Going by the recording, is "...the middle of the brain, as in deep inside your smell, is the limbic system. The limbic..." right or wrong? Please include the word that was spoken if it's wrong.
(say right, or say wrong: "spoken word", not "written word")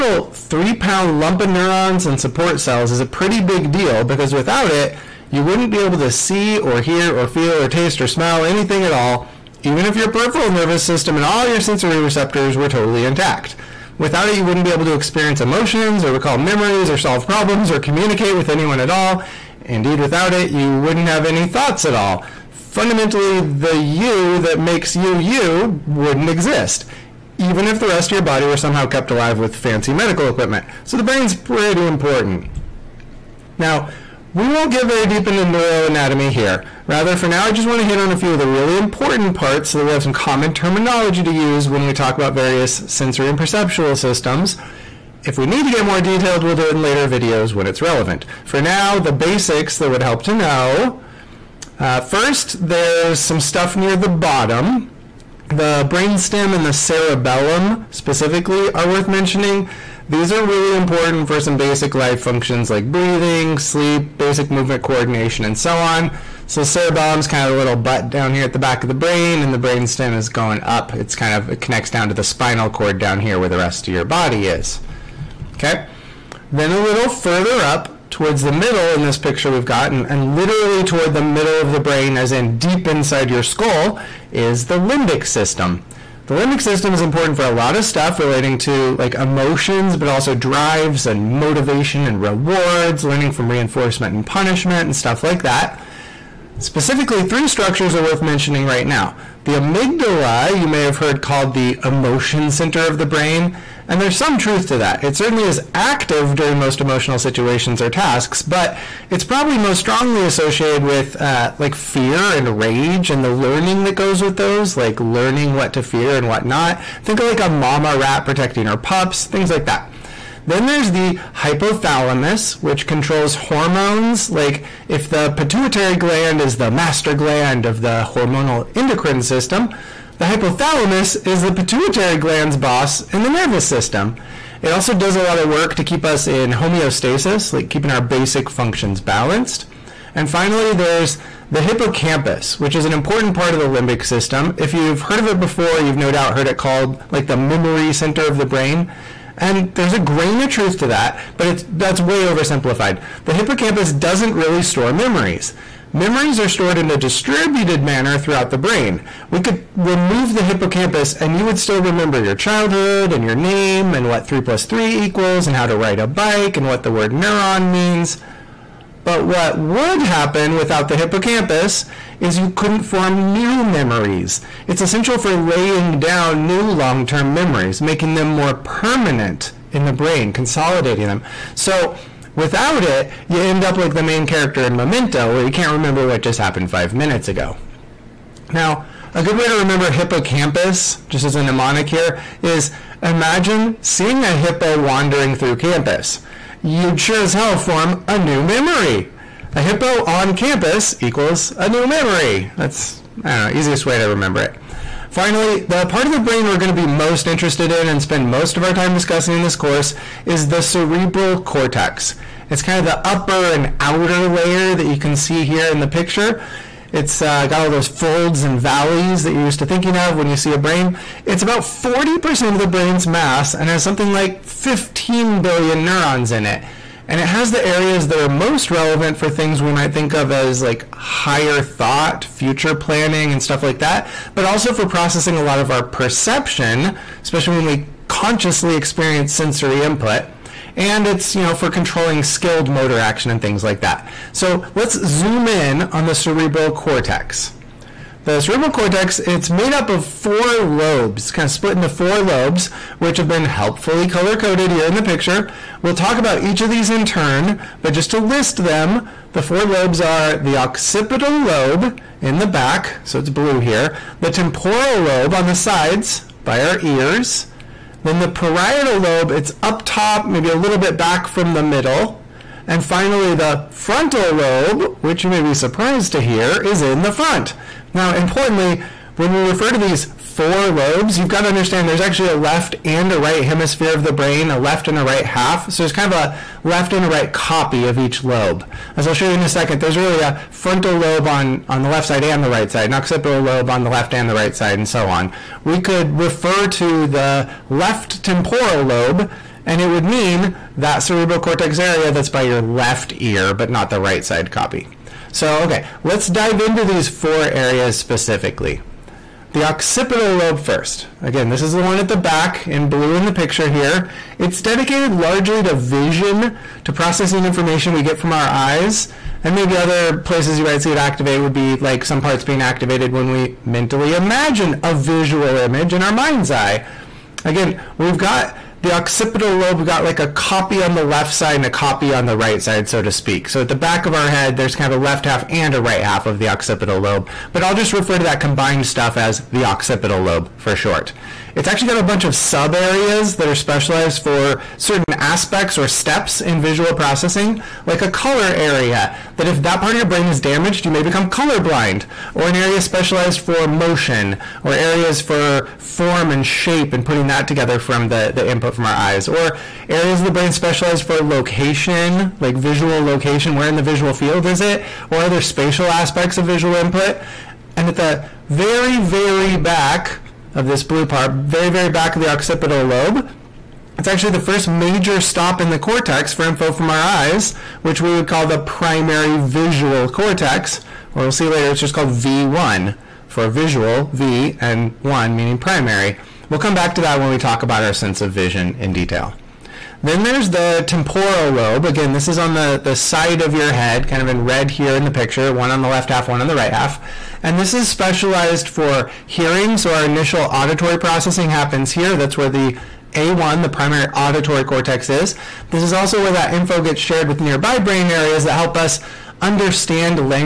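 wrong: "skull", not "smell".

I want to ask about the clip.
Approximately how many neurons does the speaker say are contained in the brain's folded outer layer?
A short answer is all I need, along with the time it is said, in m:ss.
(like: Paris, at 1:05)
15 billion, at 3:44.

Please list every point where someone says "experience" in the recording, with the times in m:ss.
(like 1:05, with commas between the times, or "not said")
0:14, 3:58.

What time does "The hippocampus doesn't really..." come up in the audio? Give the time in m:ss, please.
2:33.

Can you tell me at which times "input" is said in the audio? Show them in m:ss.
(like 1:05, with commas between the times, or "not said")
3:59, 5:58, 6:06.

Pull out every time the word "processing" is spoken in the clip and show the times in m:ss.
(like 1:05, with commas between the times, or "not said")
3:54, 5:16, 5:46, 6:40.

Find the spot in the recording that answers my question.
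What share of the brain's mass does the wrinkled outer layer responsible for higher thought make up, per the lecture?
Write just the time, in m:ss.
3:41.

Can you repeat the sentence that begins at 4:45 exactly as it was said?
So there's kind of a left and a right copy of each lobe.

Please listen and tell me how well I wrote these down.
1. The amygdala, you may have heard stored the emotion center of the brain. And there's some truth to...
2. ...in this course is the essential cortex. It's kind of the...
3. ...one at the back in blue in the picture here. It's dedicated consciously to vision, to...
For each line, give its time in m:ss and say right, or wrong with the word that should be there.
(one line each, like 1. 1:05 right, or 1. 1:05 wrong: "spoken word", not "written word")
1. 1:39 wrong: "called", not "stored"
2. 3:29 wrong: "cerebral", not "essential"
3. 5:11 wrong: "largely", not "consciously".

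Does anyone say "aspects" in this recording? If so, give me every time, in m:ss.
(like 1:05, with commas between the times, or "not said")
5:45, 6:05.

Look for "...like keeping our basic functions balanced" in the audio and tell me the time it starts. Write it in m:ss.
2:17.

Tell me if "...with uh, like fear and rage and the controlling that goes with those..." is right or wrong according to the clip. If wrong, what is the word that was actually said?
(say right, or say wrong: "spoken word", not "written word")
wrong: "learning", not "controlling".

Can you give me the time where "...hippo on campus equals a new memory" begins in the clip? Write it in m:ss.
3:19.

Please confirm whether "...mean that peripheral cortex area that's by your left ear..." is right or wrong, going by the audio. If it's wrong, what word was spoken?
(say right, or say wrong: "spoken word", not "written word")
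wrong: "cerebral", not "peripheral".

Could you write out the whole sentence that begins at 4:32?
And finally, the frontal lobe, which you may be surprised to hear, is in the front.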